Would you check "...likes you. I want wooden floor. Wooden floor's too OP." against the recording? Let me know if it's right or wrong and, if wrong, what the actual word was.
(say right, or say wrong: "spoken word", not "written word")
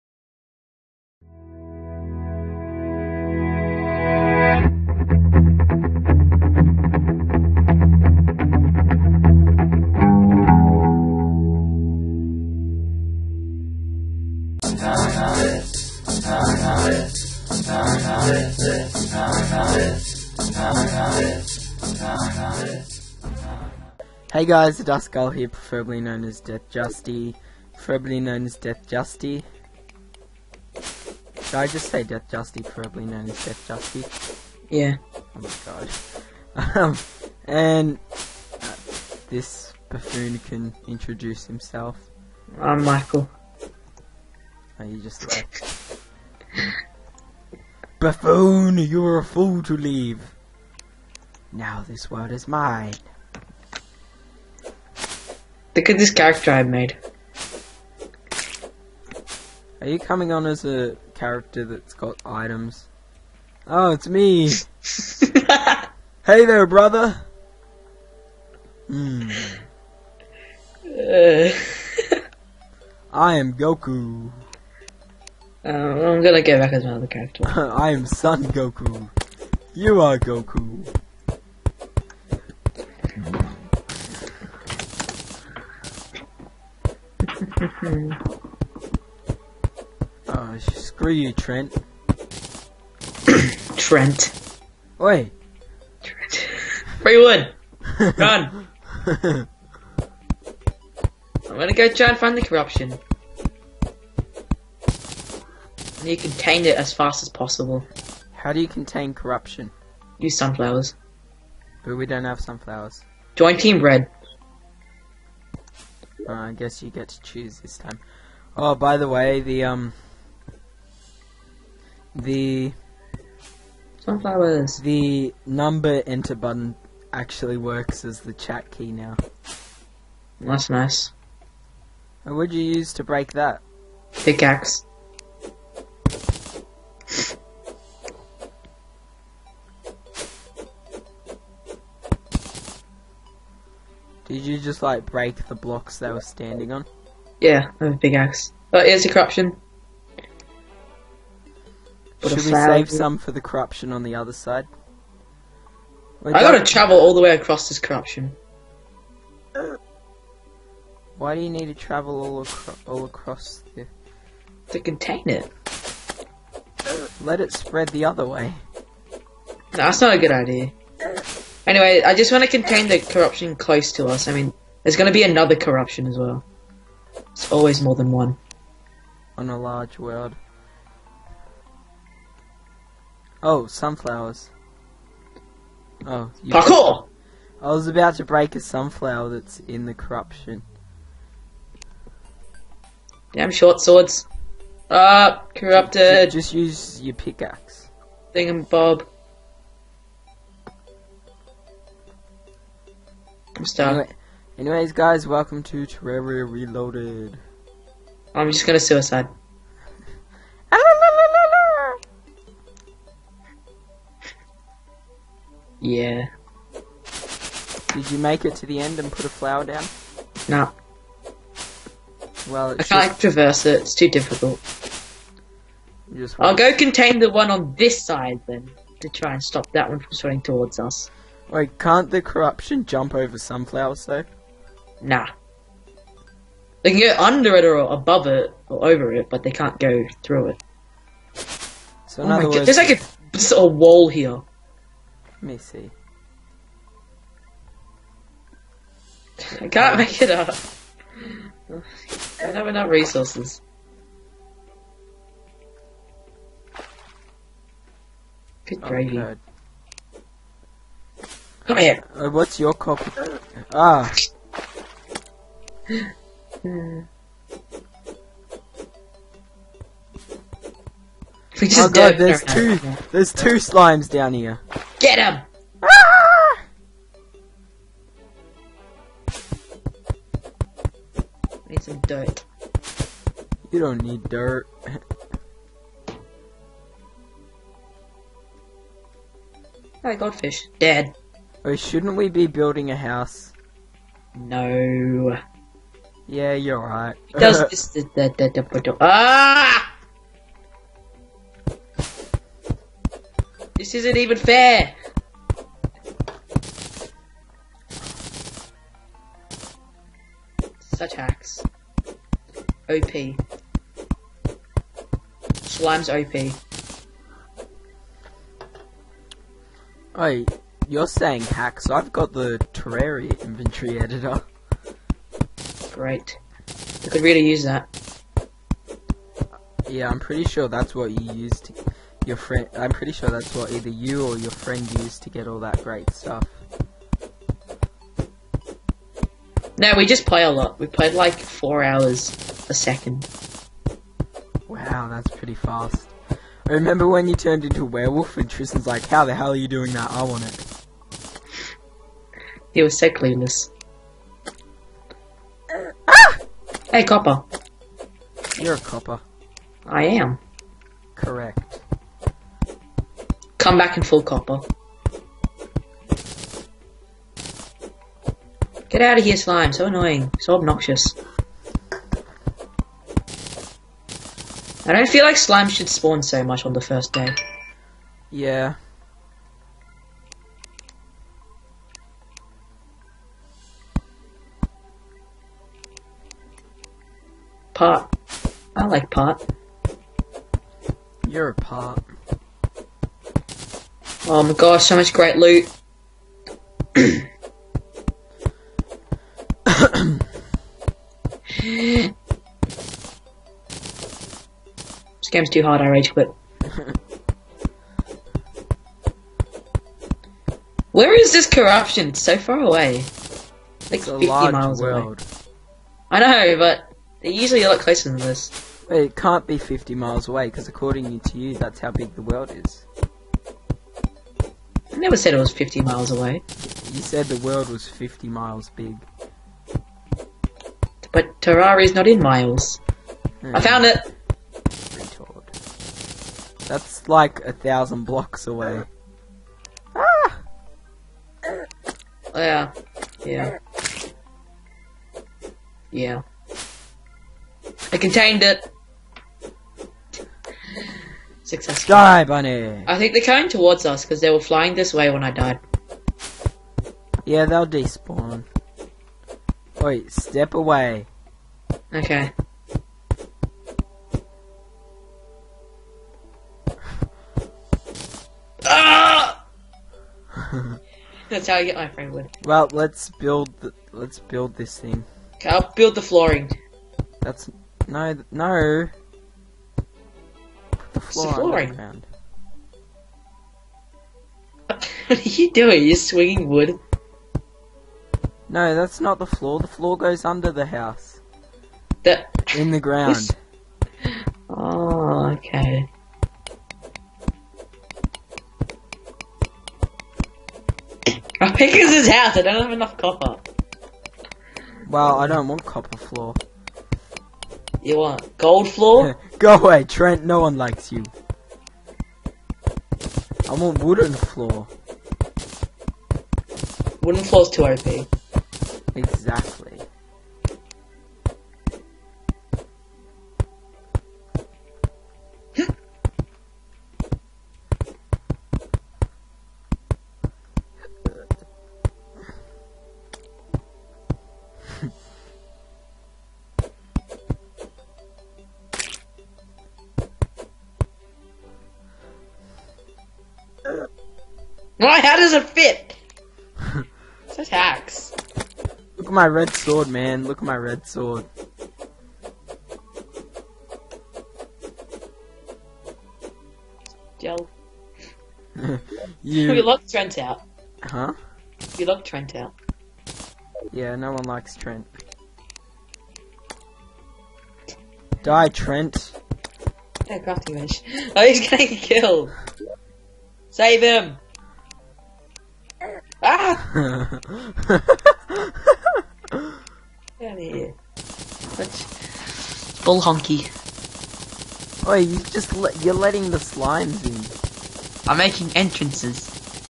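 right.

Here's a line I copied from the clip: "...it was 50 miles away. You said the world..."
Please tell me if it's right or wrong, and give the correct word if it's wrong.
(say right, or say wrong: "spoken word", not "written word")
right.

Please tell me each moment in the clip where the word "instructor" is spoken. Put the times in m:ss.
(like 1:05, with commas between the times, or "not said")
not said.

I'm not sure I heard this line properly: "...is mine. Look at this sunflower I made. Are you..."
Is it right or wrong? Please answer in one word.
wrong.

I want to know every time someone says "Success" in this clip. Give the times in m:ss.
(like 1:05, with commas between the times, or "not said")
7:31.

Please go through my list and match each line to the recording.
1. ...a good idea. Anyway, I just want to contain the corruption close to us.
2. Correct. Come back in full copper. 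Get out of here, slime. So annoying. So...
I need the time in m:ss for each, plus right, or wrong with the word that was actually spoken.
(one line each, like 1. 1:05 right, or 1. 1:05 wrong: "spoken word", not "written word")
1. 2:50 right
2. 6:01 right.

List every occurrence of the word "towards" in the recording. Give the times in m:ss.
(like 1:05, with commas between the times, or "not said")
3:50, 7:33.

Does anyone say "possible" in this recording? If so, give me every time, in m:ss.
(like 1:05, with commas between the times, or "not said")
1:47.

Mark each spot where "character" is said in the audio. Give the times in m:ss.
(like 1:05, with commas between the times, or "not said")
0:56, 1:01, 1:17.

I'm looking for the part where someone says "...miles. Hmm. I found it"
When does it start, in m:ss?
7:12.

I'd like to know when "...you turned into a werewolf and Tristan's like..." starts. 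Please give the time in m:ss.
5:47.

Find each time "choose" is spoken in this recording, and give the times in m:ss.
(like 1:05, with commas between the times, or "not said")
1:57.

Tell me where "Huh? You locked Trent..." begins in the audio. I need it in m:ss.
9:20.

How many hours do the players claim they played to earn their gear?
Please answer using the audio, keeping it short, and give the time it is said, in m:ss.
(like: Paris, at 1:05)
4, at 5:41.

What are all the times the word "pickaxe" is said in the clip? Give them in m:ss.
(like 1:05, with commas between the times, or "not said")
2:14, 3:17.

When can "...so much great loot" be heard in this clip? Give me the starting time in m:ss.
6:34.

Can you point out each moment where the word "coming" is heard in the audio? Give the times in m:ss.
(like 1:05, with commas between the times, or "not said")
0:59, 7:33.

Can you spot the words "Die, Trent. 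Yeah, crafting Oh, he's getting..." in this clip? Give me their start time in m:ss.
9:28.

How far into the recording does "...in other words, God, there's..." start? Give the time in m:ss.
4:02.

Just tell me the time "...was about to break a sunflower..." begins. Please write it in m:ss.
3:07.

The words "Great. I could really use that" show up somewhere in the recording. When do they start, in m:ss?
5:25.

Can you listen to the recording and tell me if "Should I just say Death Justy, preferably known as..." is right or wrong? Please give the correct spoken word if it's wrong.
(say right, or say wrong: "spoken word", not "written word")
right.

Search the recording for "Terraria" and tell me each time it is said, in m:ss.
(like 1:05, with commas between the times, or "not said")
3:25, 5:22, 7:11.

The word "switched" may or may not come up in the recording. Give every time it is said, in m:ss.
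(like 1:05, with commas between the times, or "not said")
not said.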